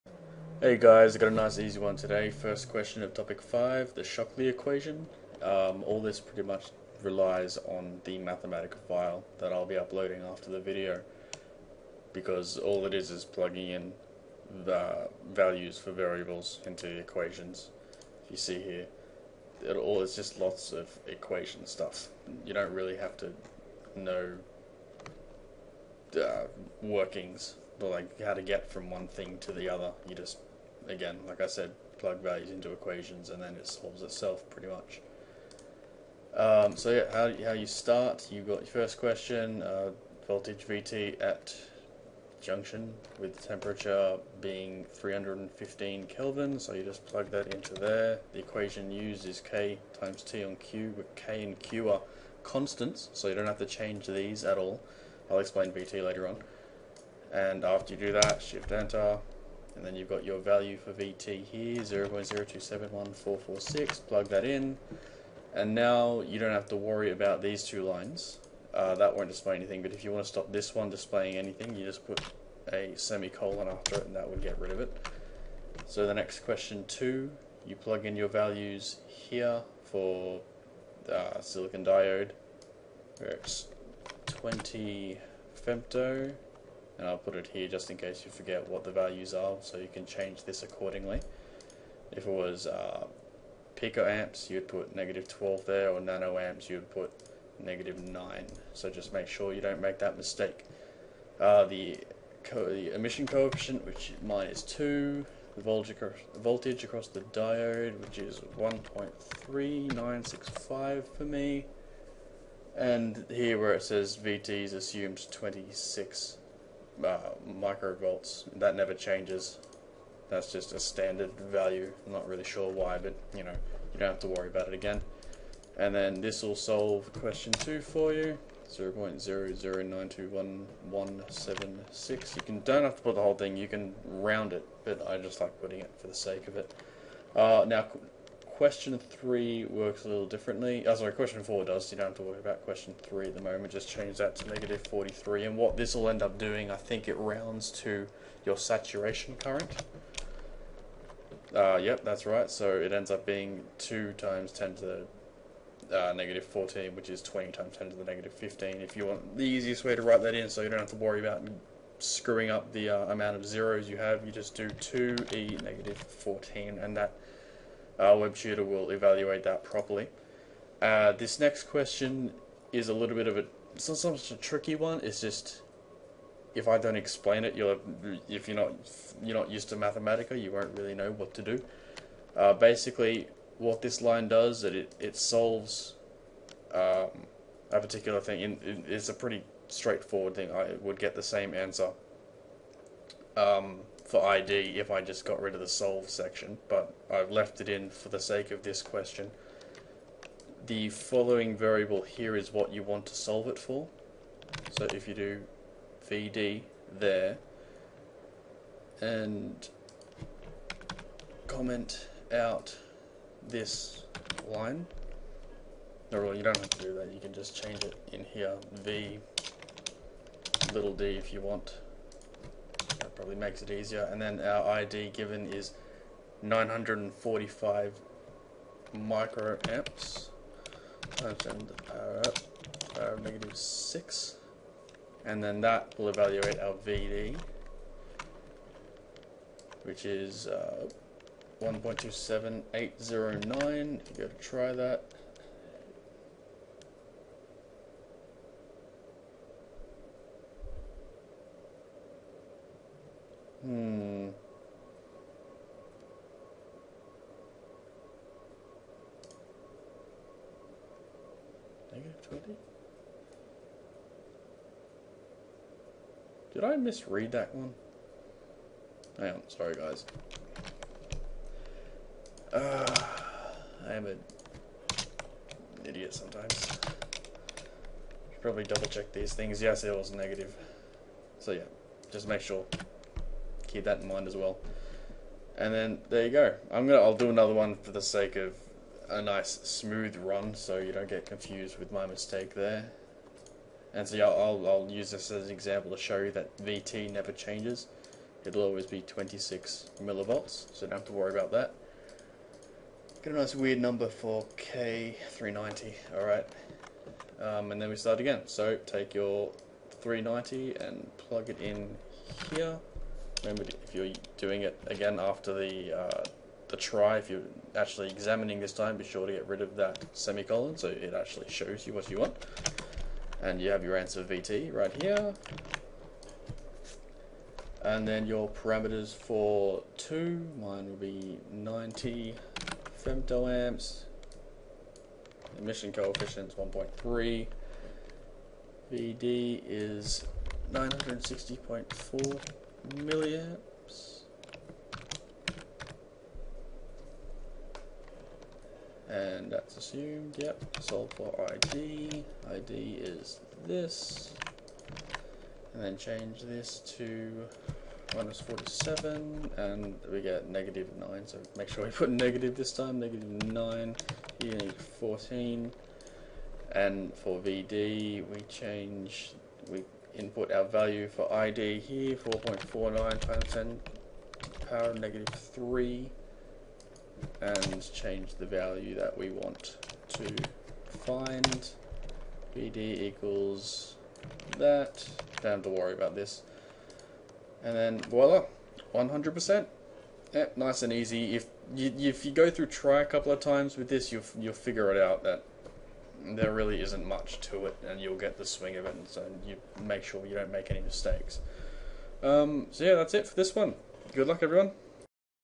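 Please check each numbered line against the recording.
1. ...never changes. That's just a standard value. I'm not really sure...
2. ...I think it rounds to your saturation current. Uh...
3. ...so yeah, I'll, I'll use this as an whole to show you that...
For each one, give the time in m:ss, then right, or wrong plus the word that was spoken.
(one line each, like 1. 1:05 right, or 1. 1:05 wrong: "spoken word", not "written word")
1. 1:58 right
2. 2:26 right
3. 4:54 wrong: "example", not "whole".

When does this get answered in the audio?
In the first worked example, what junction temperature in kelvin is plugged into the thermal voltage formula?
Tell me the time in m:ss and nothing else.
0:44.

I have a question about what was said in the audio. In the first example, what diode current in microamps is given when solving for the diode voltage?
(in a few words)
945.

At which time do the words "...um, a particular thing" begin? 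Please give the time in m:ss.
3:06.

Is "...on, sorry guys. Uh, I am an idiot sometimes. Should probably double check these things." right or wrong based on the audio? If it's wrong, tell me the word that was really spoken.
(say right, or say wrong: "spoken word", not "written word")
right.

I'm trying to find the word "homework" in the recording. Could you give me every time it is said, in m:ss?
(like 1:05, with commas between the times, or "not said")
not said.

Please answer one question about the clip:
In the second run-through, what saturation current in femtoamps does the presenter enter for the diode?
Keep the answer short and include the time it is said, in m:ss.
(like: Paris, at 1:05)
90, at 5:31.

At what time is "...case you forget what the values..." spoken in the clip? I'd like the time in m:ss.
1:27.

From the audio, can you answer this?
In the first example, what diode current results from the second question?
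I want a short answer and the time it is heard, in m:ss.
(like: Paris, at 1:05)
0.00921176, at 2:08.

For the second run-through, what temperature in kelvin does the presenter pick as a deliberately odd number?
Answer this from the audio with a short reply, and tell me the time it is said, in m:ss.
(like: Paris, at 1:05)
390, at 5:09.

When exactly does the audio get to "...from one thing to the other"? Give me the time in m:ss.
0:28.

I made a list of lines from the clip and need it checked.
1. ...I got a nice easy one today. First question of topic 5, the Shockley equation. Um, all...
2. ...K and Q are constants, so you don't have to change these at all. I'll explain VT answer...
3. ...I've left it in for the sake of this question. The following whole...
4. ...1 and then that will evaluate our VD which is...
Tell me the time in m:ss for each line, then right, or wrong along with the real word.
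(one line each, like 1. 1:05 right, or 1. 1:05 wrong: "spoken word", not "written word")
1. 0:01 right
2. 0:51 wrong: "later", not "answer"
3. 3:17 wrong: "variable", not "whole"
4. 3:53 wrong: "6", not "1".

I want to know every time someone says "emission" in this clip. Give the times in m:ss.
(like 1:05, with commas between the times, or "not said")
1:42, 5:35.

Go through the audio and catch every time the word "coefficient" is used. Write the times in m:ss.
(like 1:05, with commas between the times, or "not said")
1:43, 5:35.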